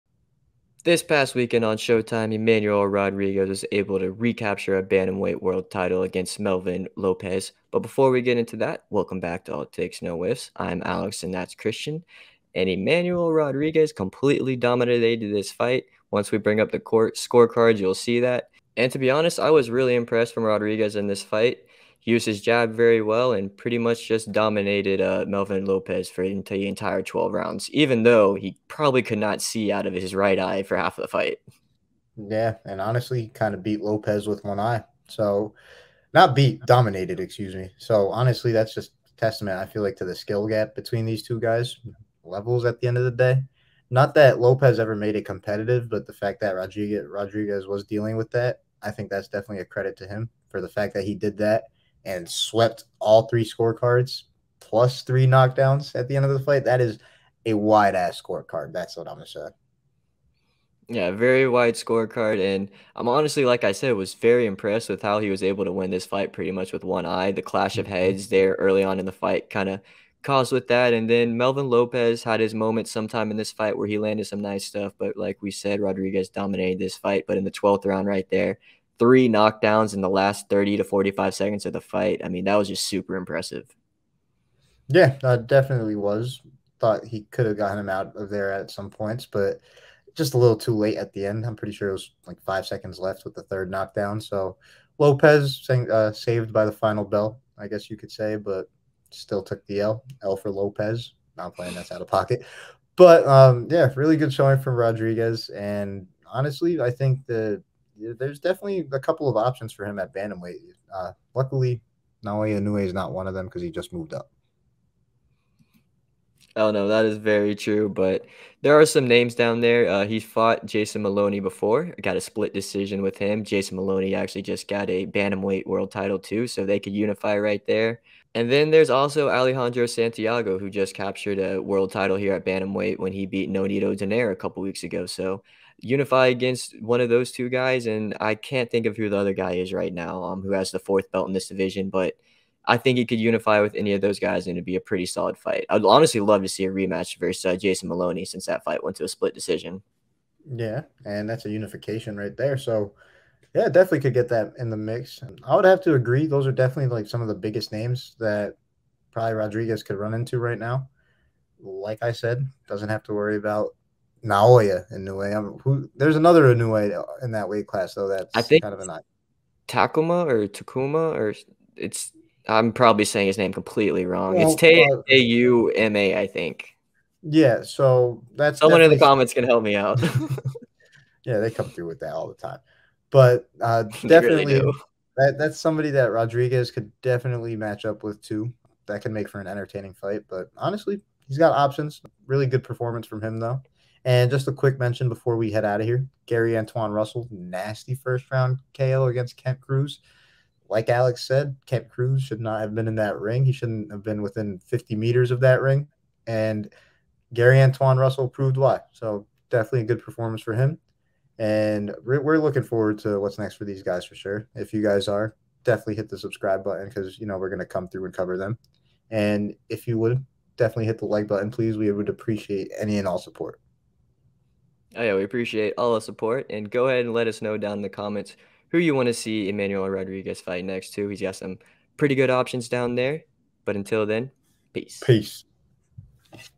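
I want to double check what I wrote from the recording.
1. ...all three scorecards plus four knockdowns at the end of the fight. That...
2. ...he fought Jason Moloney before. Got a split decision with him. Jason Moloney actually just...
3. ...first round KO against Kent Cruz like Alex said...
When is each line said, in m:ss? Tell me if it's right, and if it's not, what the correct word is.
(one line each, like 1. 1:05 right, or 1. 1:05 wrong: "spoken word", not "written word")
1. 0:52 wrong: "three", not "four"
2. 2:00 right
3. 3:17 right.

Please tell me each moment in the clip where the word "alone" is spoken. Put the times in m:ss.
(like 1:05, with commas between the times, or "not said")
not said.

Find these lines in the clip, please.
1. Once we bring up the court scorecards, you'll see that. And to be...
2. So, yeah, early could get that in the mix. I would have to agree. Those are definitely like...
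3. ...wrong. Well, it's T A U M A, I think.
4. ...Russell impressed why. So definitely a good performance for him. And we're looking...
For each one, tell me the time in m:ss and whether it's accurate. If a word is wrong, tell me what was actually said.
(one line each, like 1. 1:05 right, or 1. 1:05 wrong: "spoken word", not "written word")
1. 0:16 right
2. 2:32 wrong: "definitely", not "early"
3. 2:54 right
4. 3:27 wrong: "proved", not "impressed".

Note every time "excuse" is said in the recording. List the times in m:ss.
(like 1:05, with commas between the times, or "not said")
0:37.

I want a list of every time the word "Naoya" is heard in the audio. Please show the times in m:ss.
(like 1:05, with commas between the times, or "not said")
1:52, 2:44.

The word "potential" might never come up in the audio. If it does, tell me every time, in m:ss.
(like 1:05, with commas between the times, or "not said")
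not said.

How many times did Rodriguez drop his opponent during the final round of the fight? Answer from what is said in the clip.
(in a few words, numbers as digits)
3.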